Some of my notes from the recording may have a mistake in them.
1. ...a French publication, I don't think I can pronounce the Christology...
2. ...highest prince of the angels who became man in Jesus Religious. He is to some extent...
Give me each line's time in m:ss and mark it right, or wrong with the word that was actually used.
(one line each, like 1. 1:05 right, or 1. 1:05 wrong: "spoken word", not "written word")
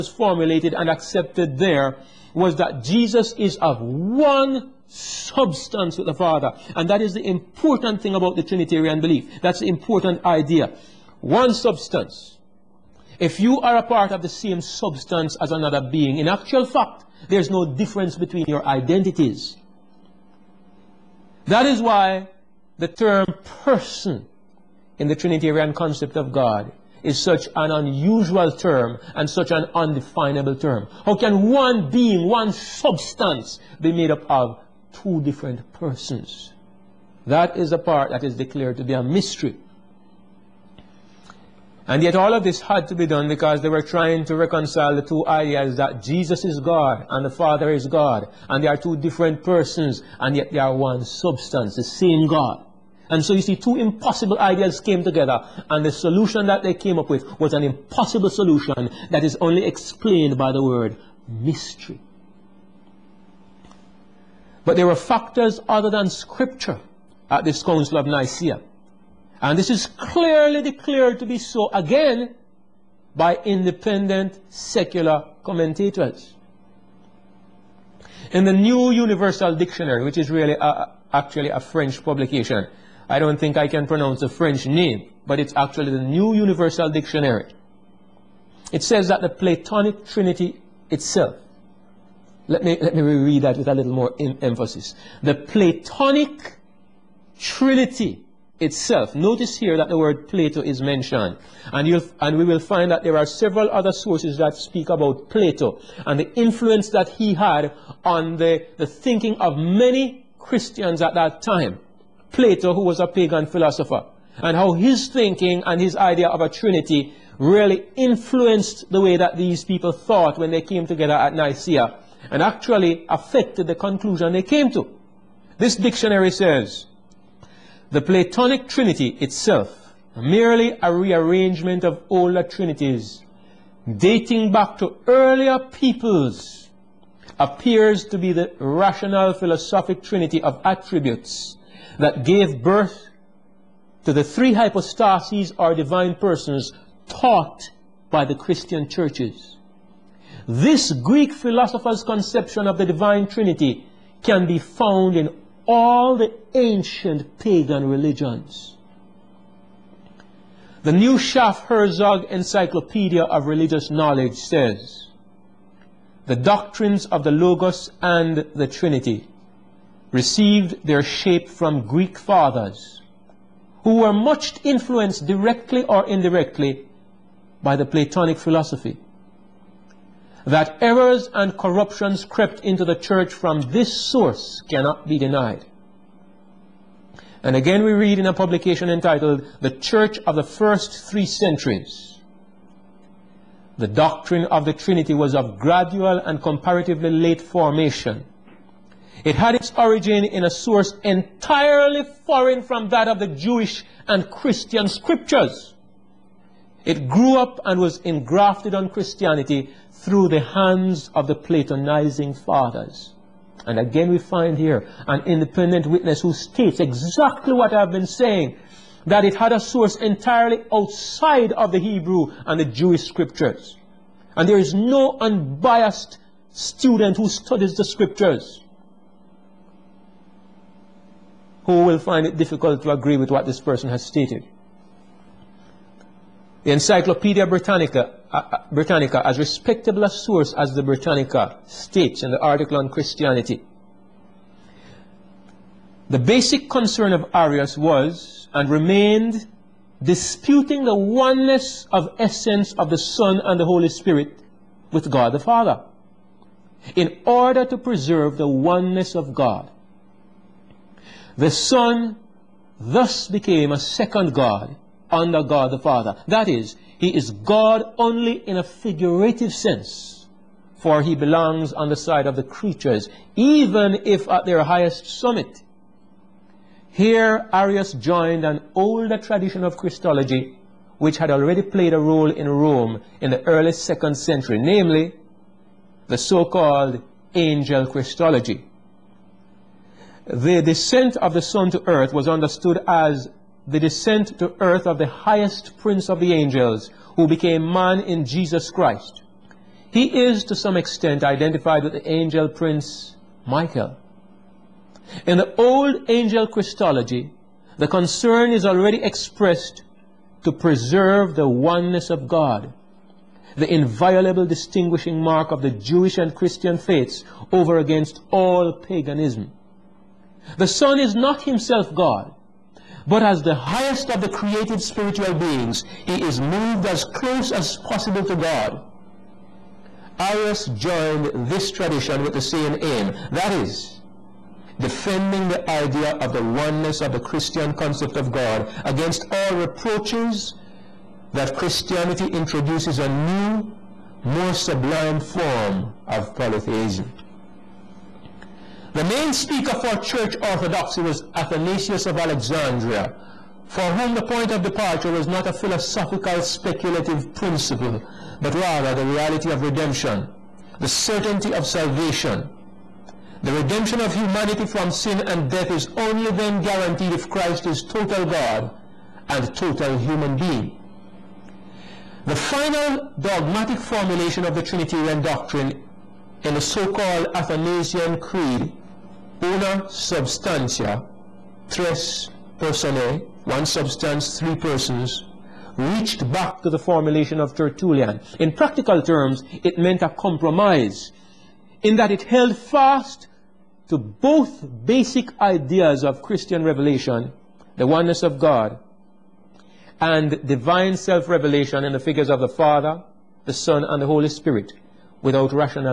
1. 1:21 wrong: "French", not "Christology"
2. 4:55 wrong: "Christ", not "Religious".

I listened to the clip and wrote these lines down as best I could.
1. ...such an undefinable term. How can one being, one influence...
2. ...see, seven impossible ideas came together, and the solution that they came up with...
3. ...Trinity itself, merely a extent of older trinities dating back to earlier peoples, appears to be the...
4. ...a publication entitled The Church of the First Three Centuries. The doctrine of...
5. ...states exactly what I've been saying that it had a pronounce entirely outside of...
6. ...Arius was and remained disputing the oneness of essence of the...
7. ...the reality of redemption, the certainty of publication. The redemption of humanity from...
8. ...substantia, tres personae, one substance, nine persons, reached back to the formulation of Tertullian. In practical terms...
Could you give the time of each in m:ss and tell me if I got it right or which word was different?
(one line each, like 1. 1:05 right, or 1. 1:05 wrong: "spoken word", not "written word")
1. 0:29 wrong: "substance", not "influence"
2. 0:53 wrong: "two", not "seven"
3. 2:08 wrong: "rearrangement", not "extent"
4. 3:08 right
5. 3:36 wrong: "source", not "pronounce"
6. 4:07 right
7. 5:58 wrong: "salvation", not "publication"
8. 6:19 wrong: "three", not "nine".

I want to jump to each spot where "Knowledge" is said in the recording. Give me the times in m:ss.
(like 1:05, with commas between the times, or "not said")
2:43.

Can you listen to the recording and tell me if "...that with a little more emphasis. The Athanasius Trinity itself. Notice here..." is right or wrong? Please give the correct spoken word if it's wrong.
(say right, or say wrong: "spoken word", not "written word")
wrong: "Platonic", not "Athanasius".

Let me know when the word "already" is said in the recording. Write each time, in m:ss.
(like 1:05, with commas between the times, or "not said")
4:41, 5:08.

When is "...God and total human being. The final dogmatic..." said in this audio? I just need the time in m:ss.
6:08.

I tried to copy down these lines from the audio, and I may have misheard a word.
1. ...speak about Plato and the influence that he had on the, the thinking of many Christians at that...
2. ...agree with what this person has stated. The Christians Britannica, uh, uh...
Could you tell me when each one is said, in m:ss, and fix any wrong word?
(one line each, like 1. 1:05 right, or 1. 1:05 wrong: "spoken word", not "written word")
1. 1:44 right
2. 3:52 wrong: "Encyclopedia", not "Christians".